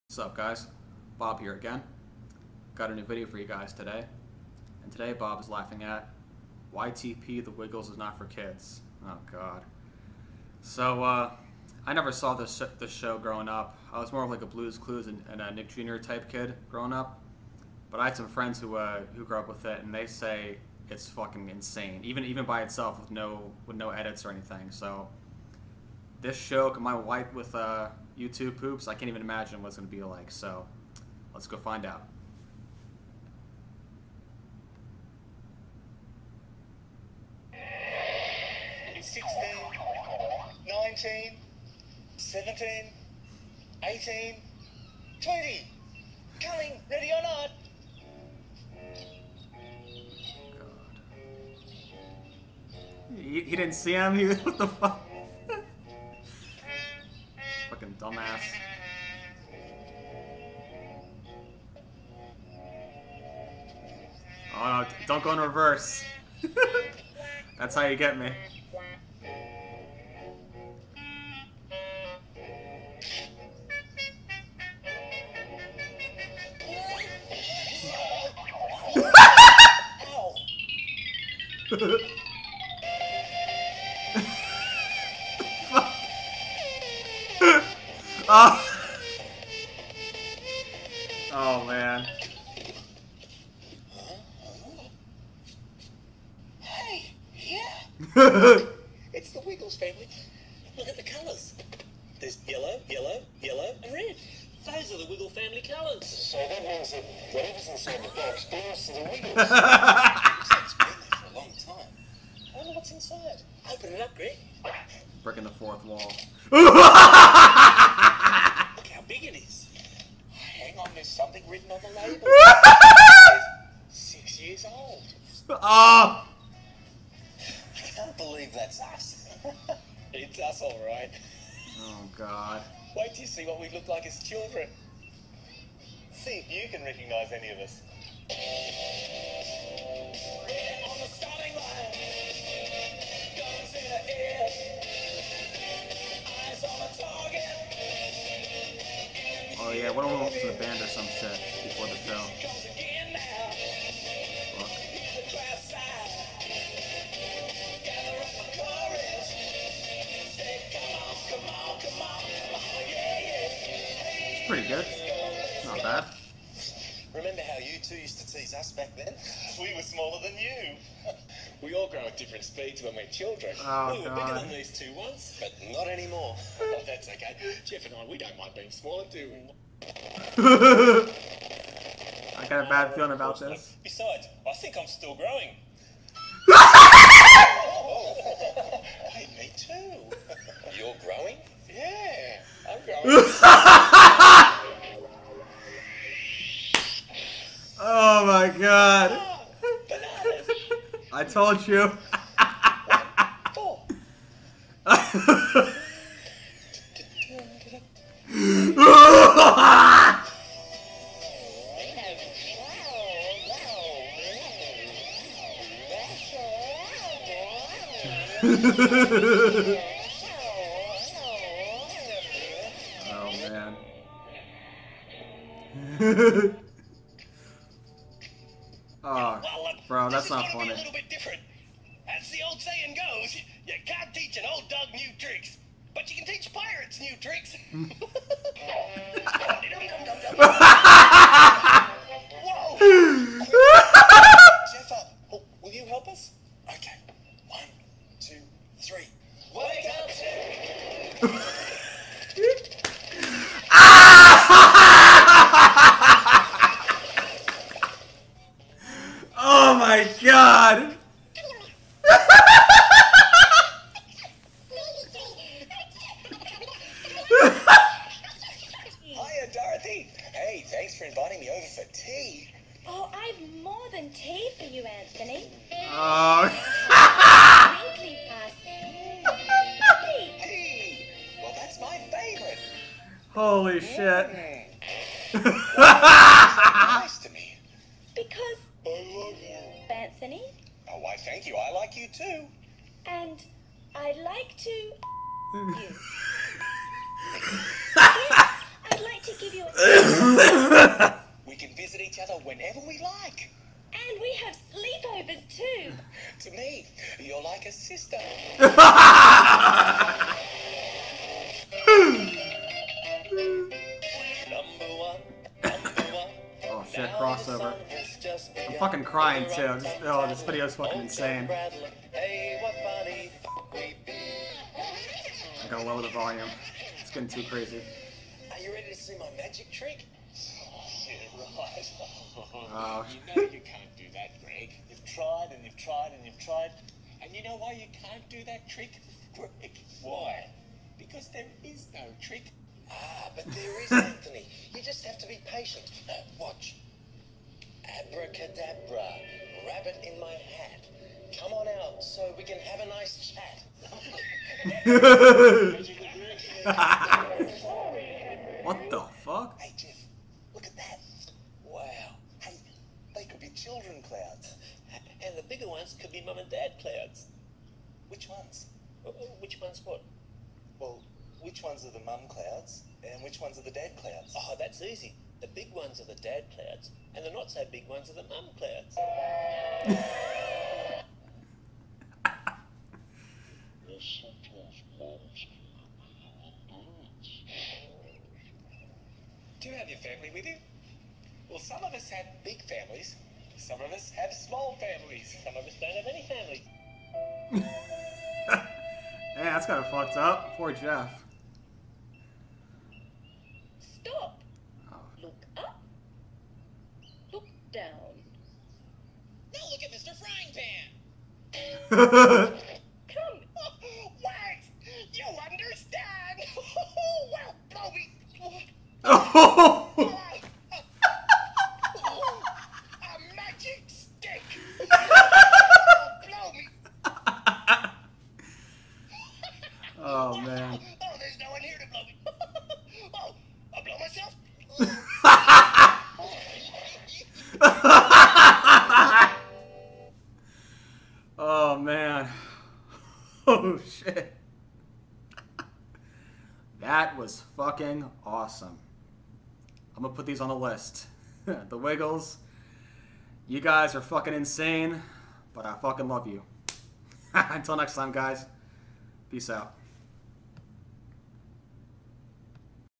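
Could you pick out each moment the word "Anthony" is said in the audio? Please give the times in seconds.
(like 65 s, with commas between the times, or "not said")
274 s, 289 s, 343 s.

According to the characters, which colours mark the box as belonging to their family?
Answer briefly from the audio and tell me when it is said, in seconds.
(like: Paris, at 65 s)
yellow and red, at 102 s.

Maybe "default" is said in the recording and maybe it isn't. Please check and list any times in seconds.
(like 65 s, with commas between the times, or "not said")
not said.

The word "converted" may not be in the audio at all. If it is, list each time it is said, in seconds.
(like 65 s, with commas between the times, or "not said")
not said.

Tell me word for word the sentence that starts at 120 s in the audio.
Hang on, there's something written on the label.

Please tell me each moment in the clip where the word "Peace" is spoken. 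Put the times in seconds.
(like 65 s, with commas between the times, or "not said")
459 s.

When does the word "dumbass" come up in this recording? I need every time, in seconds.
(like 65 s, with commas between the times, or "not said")
57 s.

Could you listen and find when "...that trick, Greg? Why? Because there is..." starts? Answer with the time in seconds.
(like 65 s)
338 s.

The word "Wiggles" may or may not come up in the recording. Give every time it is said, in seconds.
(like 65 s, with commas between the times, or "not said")
7 s, 99 s, 105 s, 109 s, 451 s.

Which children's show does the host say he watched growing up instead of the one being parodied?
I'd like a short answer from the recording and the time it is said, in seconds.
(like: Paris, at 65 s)
Blues Clues, at 14 s.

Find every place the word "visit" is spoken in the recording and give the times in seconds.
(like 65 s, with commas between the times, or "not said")
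301 s.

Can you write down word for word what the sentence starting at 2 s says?
Got a new video for you guys today.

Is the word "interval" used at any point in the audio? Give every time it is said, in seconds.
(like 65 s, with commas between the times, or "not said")
not said.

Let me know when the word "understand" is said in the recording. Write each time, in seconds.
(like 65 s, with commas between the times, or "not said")
415 s.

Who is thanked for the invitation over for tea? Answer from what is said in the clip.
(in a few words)
Dorothy.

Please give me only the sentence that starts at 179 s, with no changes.
I got a bad feeling about this.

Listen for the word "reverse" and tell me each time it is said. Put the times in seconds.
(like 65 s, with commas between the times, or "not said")
65 s.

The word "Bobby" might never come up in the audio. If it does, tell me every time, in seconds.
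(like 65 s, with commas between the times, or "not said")
419 s.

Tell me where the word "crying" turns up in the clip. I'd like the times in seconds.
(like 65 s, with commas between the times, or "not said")
319 s.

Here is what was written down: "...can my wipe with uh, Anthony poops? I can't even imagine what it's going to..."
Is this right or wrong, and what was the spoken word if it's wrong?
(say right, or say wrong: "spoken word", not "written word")
wrong: "YouTube", not "Anthony".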